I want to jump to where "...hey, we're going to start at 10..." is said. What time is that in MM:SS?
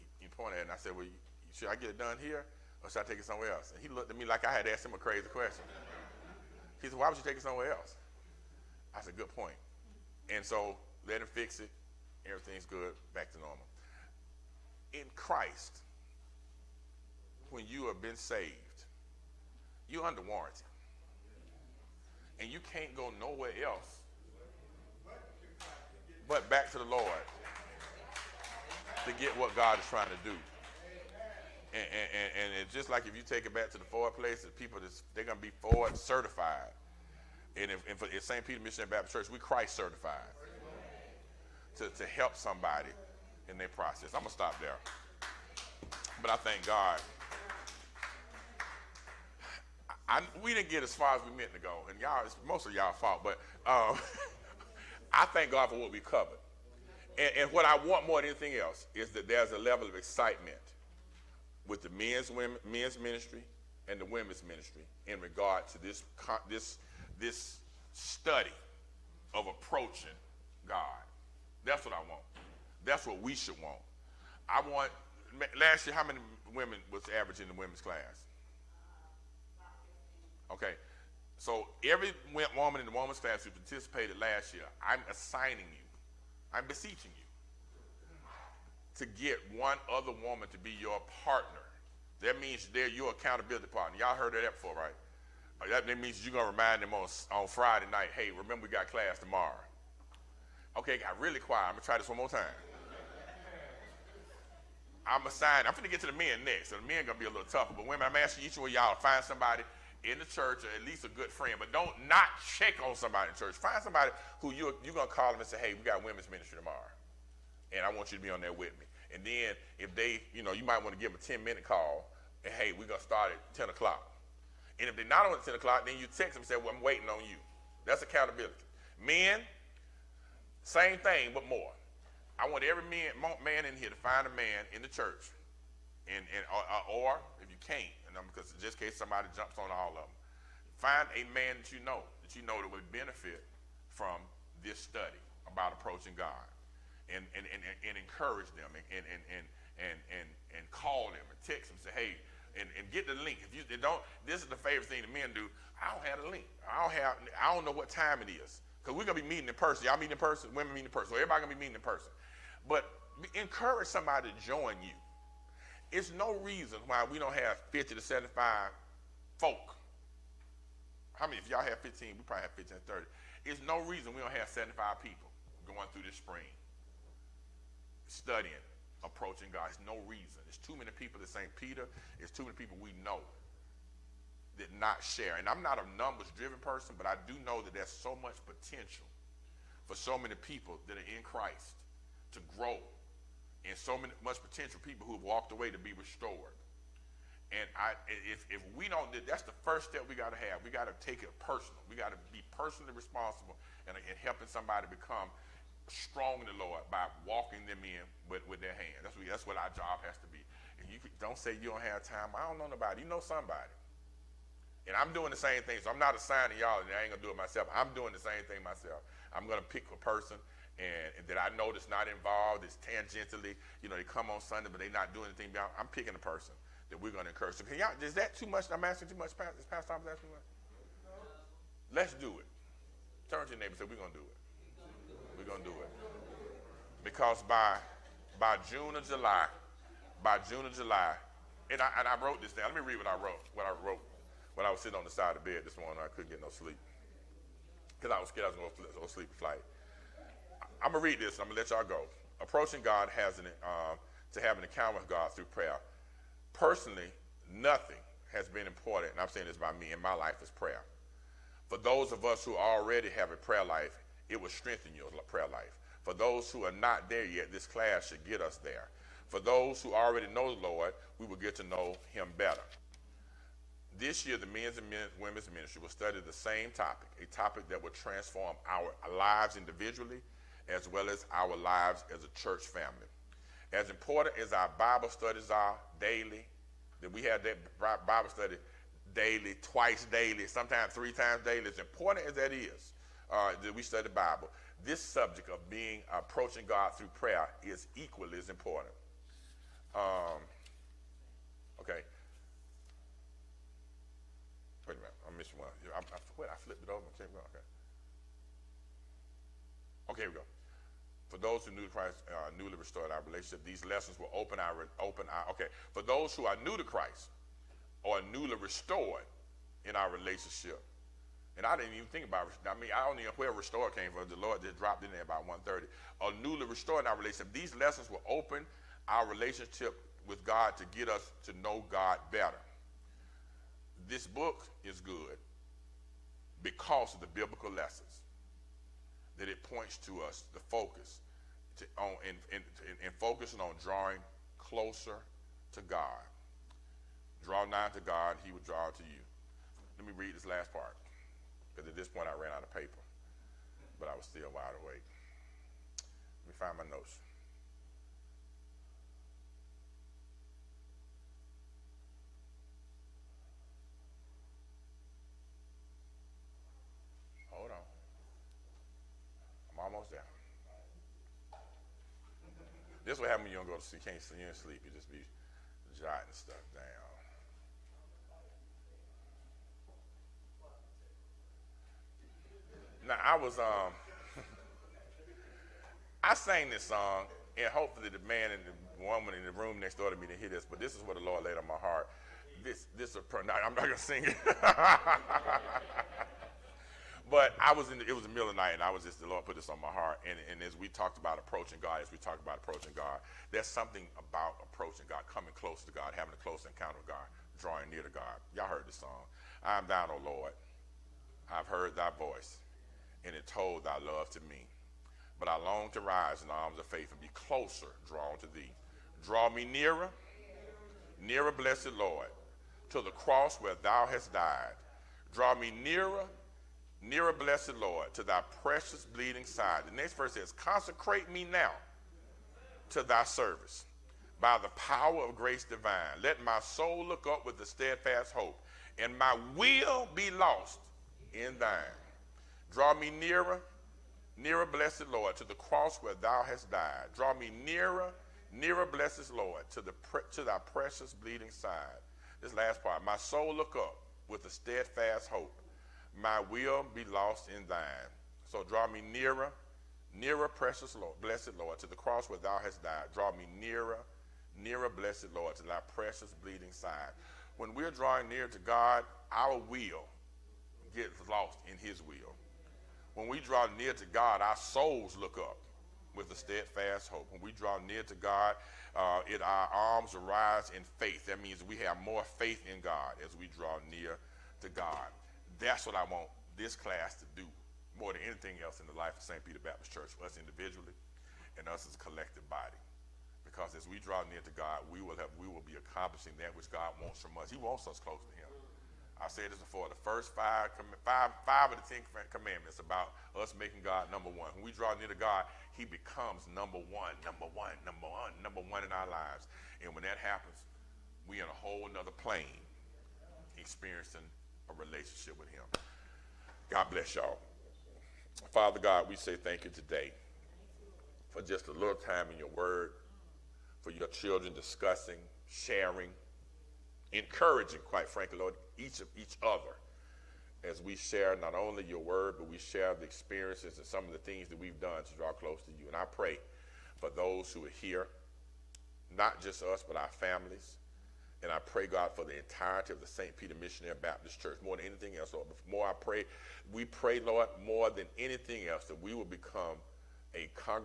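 02:02.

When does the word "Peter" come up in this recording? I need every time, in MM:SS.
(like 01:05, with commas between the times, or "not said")
00:38, 03:01, 08:09, 09:03.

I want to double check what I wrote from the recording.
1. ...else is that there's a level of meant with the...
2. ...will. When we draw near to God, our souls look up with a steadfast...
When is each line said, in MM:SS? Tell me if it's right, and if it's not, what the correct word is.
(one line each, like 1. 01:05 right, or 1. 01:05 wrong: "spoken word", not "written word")
1. 00:58 wrong: "excitement", not "meant"
2. 07:52 right.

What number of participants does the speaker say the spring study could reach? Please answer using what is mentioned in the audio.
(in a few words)
75.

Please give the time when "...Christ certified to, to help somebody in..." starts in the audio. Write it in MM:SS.
00:39.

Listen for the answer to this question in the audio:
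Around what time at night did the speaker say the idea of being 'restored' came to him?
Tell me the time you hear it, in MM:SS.
05:25.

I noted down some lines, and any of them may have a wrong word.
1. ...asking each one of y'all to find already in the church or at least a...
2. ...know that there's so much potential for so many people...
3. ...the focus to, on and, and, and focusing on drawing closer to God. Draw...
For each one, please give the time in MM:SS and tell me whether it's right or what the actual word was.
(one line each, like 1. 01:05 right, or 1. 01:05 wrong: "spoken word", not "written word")
1. 01:48 wrong: "somebody", not "already"
2. 03:07 right
3. 05:40 right.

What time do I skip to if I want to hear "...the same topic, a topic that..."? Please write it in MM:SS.
04:36.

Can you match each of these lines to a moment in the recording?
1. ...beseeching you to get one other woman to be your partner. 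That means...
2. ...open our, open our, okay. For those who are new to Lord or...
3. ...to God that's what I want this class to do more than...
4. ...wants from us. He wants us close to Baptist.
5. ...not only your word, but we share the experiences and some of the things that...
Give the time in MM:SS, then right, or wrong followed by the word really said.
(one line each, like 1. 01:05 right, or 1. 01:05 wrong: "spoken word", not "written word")
1. 01:26 right
2. 05:14 wrong: "Christ", not "Lord"
3. 08:04 right
4. 08:17 wrong: "Him", not "Baptist"
5. 08:51 right.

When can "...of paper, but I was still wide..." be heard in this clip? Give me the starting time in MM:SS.
05:52.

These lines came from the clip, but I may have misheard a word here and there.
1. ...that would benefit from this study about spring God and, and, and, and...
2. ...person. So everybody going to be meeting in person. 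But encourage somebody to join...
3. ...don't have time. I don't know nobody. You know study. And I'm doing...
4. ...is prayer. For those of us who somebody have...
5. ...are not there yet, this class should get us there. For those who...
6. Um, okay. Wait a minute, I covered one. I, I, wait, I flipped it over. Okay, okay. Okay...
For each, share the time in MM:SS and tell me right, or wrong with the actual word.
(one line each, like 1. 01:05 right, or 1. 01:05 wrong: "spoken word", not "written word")
1. 02:22 wrong: "approaching", not "spring"
2. 02:40 right
3. 03:31 wrong: "somebody", not "study"
4. 04:20 wrong: "already", not "somebody"
5. 04:26 right
6. 04:59 wrong: "missed", not "covered".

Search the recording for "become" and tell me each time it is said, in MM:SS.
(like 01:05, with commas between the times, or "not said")
03:24, 08:25, 09:09.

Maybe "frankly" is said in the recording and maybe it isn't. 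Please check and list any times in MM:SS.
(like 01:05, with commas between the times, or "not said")
08:48.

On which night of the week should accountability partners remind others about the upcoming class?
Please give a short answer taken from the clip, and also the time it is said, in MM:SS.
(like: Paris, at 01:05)
Friday, at 01:37.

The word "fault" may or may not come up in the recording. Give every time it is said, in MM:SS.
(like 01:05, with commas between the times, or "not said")
00:52.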